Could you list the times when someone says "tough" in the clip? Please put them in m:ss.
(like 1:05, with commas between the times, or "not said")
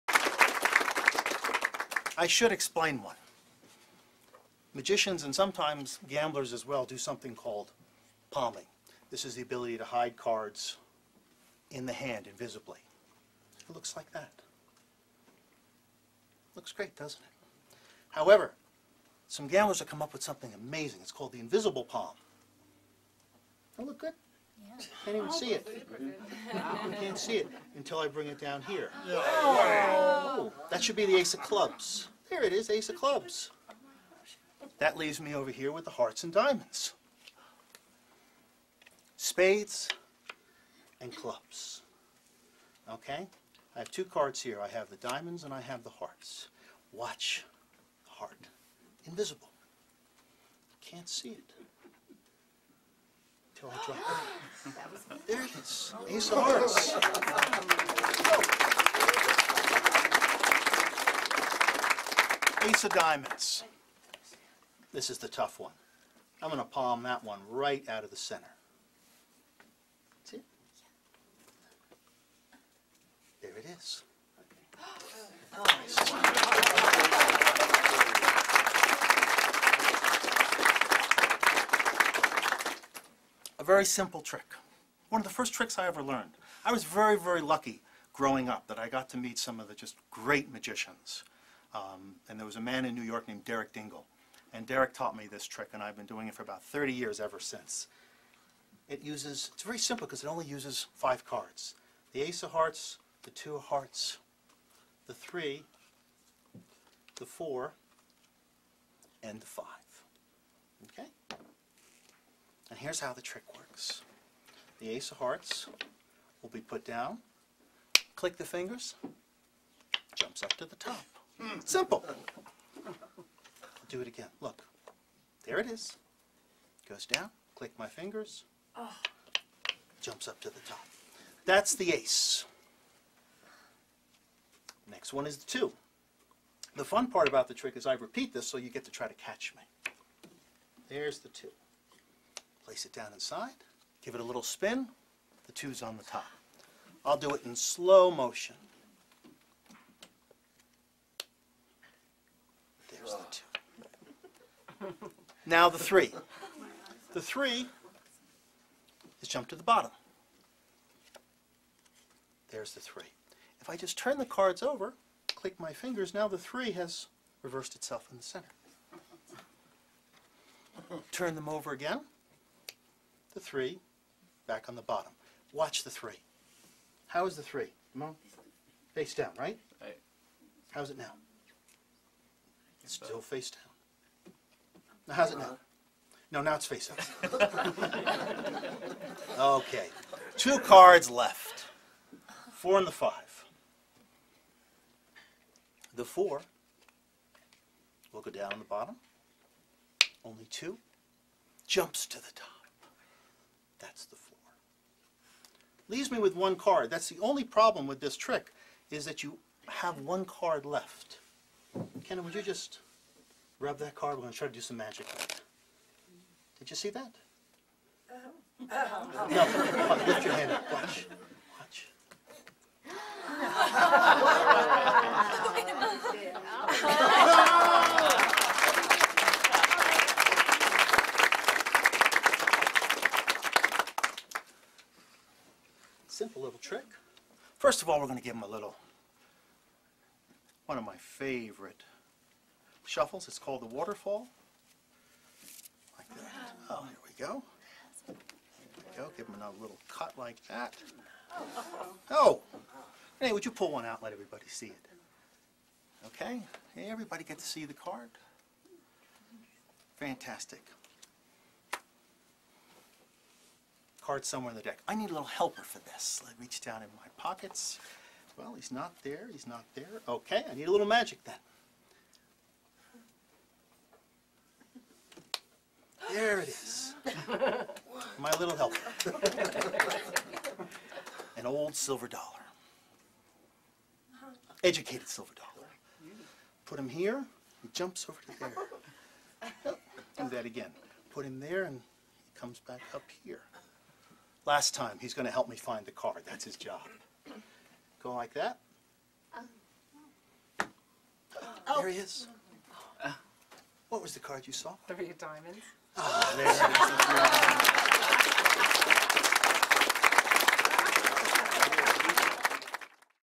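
1:05.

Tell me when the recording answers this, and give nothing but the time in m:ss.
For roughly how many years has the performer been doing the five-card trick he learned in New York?
1:36.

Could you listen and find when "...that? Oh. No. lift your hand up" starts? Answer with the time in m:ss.
3:36.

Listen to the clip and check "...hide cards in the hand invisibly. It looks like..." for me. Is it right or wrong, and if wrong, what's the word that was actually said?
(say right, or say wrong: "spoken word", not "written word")
right.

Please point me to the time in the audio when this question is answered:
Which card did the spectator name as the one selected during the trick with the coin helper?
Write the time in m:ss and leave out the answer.
5:04.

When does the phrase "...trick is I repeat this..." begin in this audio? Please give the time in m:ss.
2:17.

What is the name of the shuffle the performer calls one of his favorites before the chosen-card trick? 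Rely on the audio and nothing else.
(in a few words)
the waterfall.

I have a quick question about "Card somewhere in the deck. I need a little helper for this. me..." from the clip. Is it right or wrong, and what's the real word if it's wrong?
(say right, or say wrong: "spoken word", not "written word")
right.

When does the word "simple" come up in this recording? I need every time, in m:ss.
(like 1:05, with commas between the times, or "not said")
1:23, 1:39, 2:01, 3:56.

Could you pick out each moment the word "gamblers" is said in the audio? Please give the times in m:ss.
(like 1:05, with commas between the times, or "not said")
0:06, 0:19.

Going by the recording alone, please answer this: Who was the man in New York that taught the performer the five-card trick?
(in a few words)
Derek Dingle.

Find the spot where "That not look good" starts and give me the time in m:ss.
0:23.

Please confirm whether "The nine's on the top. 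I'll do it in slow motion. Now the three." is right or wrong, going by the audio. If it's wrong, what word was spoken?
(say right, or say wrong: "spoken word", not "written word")
wrong: "two", not "nine".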